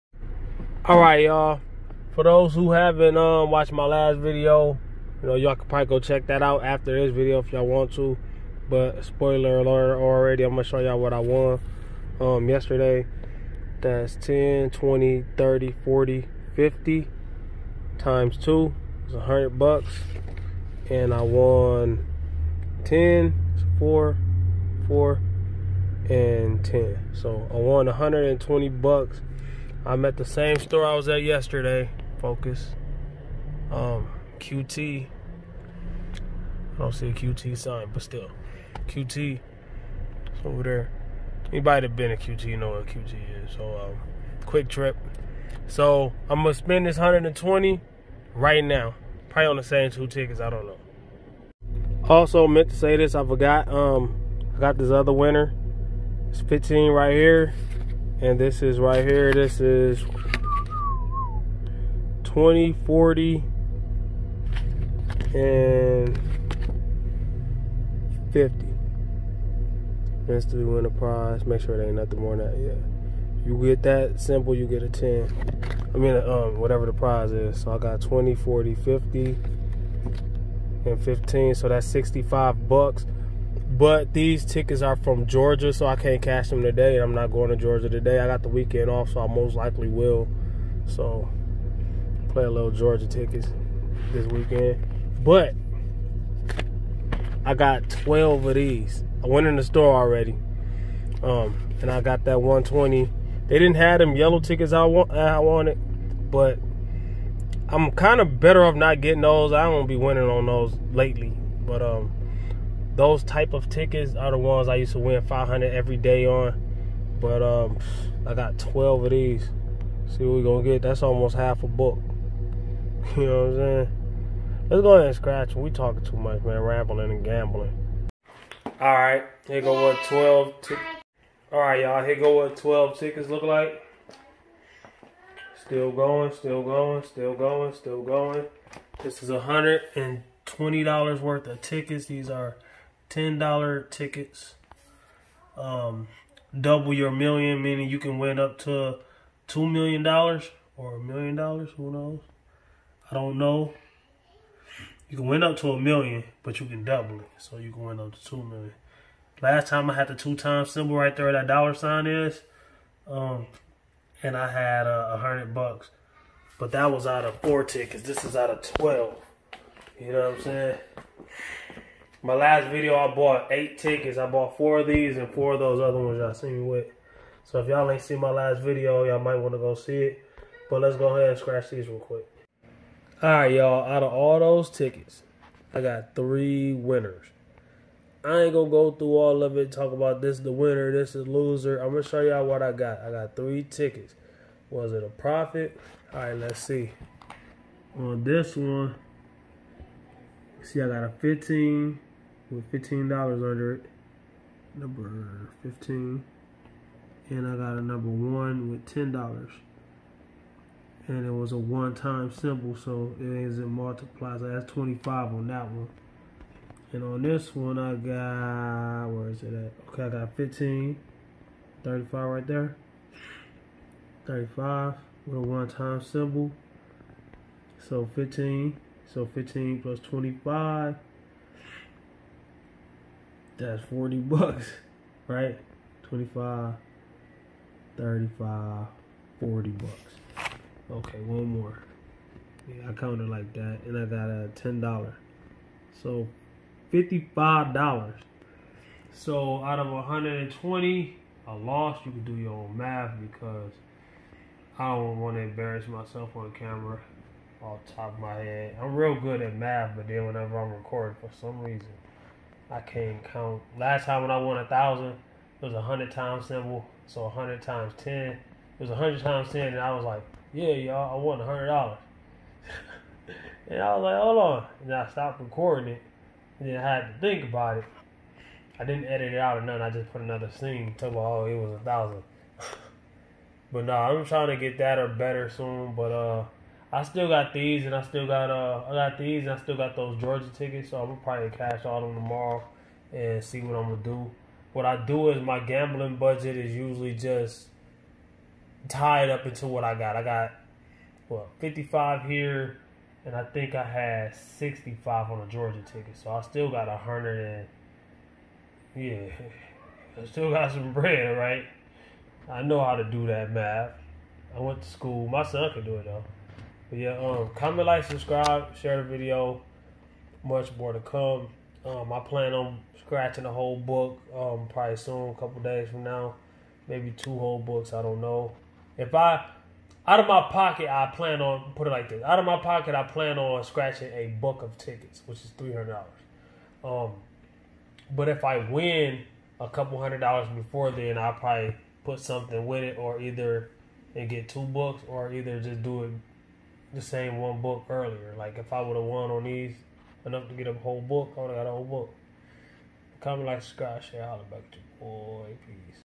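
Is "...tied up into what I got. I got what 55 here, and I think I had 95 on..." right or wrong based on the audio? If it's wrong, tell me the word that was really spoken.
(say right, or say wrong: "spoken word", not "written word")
wrong: "65", not "95".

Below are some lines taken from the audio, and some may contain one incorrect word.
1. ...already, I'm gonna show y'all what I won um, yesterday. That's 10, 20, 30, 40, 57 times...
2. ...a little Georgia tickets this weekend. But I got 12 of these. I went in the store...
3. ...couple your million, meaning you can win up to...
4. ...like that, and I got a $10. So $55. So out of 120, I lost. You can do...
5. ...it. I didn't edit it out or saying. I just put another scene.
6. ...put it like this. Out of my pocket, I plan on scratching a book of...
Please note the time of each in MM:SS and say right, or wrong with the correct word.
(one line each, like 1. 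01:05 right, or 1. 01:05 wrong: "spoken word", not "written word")
1. 00:09 wrong: "50", not "57"
2. 01:32 right
3. 02:26 wrong: "double", not "couple"
4. 04:03 right
5. 04:37 wrong: "nothing", not "saying"
6. 05:31 right.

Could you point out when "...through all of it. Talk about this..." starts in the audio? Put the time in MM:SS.
03:08.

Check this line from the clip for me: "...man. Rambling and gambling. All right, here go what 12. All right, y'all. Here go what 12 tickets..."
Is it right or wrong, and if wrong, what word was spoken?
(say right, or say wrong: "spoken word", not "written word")
right.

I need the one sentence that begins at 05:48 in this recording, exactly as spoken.
Like if I would have won on these enough to get a whole book, I would have got a whole book.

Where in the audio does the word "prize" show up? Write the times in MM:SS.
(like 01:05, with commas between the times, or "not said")
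01:10, 01:16.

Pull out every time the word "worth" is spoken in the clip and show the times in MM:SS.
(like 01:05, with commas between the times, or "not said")
02:21.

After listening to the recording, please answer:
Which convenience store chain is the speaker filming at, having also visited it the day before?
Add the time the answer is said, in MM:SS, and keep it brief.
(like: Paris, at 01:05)
QuikTrip, at 00:44.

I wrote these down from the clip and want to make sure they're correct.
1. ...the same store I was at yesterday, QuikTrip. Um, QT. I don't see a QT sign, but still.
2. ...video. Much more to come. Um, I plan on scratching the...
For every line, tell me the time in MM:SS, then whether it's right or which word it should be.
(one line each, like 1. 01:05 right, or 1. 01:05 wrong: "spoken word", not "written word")
1. 00:30 wrong: "Focus", not "QuikTrip"
2. 05:19 right.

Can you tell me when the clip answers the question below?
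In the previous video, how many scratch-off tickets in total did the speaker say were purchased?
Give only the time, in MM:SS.
02:53.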